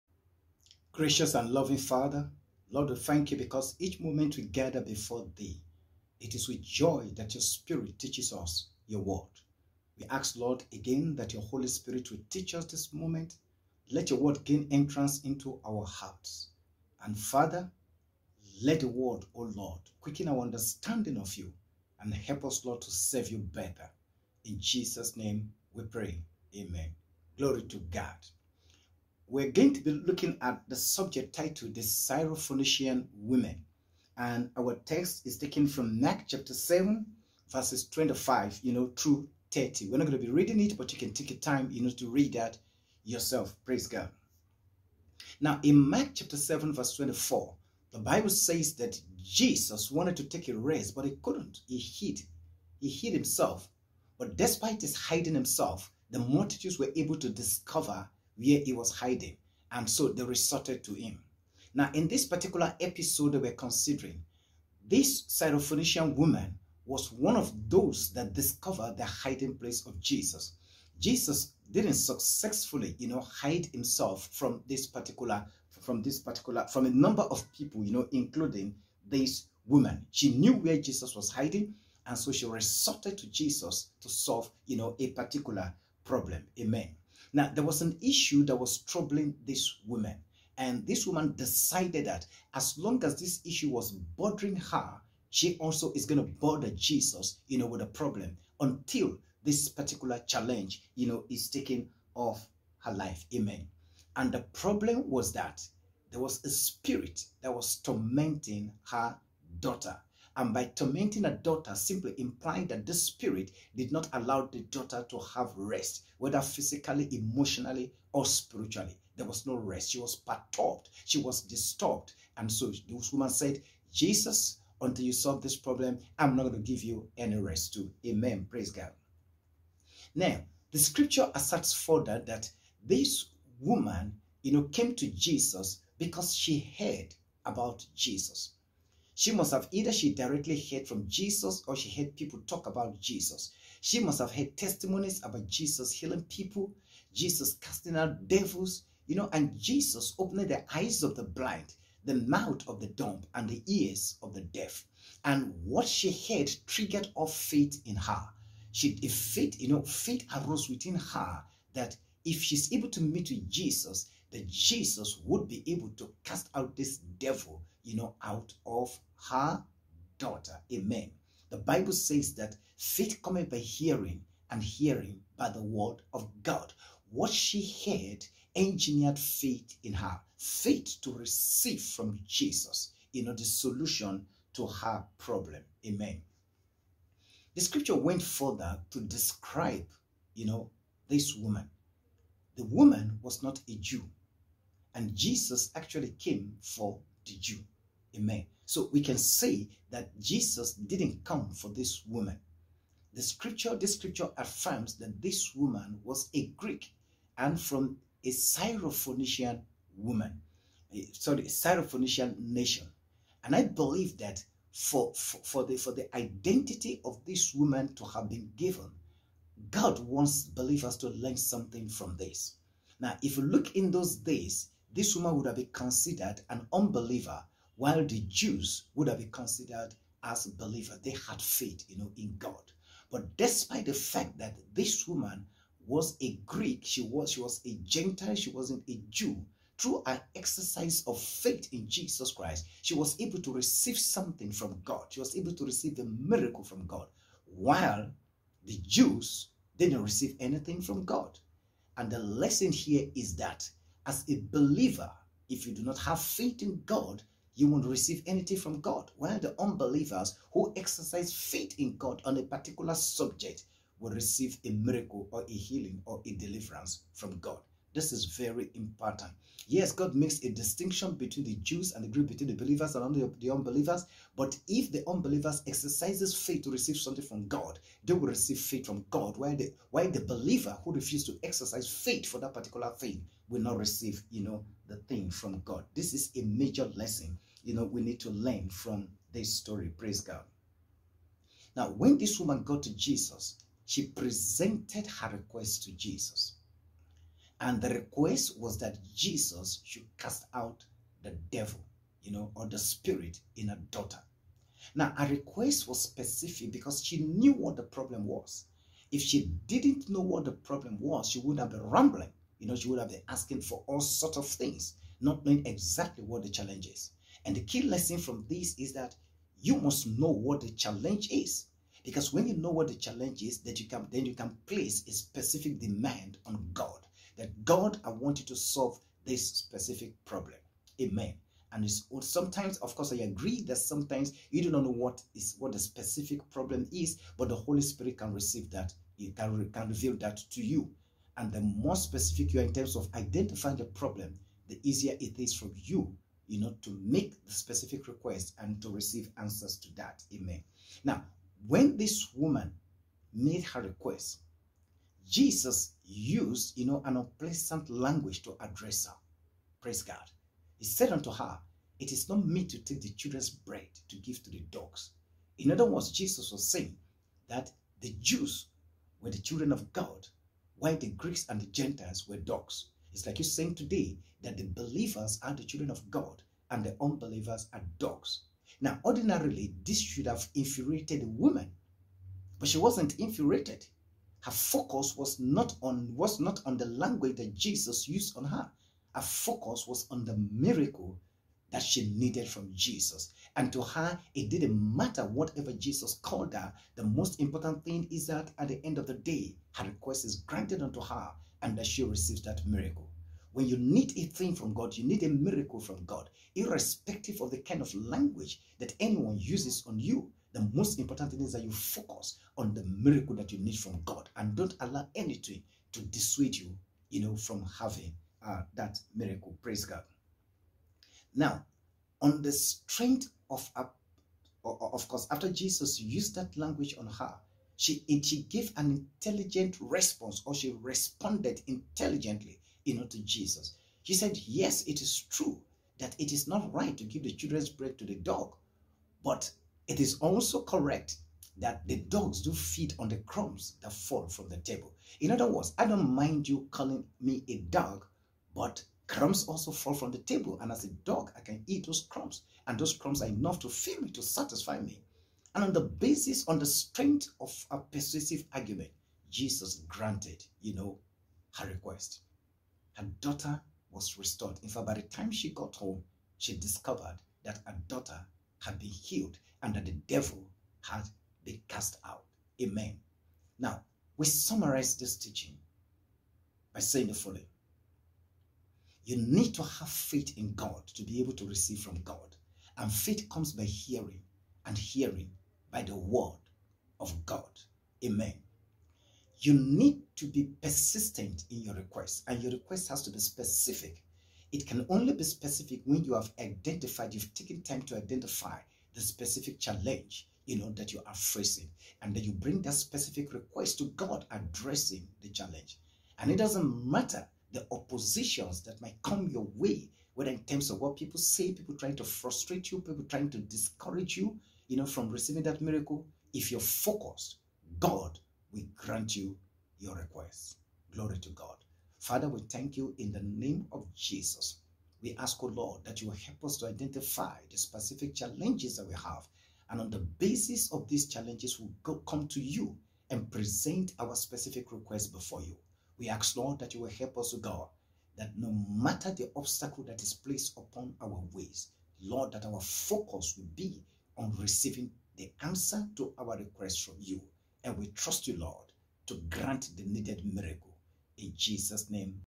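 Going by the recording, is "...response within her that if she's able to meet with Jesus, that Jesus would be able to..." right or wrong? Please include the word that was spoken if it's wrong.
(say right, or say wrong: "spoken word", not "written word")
wrong: "arose", not "response".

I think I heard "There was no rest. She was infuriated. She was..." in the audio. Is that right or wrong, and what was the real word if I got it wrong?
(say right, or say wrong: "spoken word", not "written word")
wrong: "perturbed", not "infuriated".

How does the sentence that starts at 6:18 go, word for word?
Now, ordinarily, this should have infuriated the woman, but she wasn't infuriated.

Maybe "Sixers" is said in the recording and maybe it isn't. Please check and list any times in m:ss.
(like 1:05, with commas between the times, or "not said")
not said.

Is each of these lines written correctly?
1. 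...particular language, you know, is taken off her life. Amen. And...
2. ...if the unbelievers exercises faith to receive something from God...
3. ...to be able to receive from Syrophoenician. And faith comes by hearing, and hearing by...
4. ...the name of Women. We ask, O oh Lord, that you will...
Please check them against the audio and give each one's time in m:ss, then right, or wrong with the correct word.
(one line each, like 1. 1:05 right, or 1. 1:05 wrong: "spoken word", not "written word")
1. 1:39 wrong: "challenge", not "language"
2. 4:34 right
3. 8:00 wrong: "God", not "Syrophoenician"
4. 8:43 wrong: "Jesus", not "Women".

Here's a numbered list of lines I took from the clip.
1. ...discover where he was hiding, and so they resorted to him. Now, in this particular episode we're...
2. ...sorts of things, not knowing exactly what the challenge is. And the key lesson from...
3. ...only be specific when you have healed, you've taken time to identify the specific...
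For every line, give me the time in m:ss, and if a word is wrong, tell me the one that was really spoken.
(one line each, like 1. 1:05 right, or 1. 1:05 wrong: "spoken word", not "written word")
1. 0:57 right
2. 5:14 right
3. 8:14 wrong: "identified", not "healed".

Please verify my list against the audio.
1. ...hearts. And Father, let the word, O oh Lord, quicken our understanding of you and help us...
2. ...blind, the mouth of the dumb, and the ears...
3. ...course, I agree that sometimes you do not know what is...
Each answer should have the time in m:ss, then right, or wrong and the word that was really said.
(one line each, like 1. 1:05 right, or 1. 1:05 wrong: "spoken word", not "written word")
1. 0:15 right
2. 2:31 right
3. 5:32 right.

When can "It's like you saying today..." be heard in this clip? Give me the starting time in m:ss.
6:13.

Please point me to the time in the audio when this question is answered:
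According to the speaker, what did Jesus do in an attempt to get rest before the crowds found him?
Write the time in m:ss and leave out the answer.
0:52.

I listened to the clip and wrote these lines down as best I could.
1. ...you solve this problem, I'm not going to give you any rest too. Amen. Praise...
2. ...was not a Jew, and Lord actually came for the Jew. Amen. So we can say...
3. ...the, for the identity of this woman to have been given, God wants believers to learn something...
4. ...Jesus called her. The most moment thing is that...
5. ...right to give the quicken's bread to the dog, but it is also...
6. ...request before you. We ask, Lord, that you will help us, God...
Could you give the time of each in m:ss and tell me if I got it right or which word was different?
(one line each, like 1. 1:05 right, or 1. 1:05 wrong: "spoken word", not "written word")
1. 2:05 right
2. 3:13 wrong: "Jesus", not "Lord"
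3. 3:35 right
4. 6:35 wrong: "important", not "moment"
5. 7:16 wrong: "children", not "quicken"
6. 8:54 right.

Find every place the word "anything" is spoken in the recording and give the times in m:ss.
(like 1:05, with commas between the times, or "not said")
4:10, 4:18, 6:55.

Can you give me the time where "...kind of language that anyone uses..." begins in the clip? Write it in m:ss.
6:47.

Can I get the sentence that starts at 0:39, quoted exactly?
We're not going to be reading it, but you can take your time, you know, to read that yourself.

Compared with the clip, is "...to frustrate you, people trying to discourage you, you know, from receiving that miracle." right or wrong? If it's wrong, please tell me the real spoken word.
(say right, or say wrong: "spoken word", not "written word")
right.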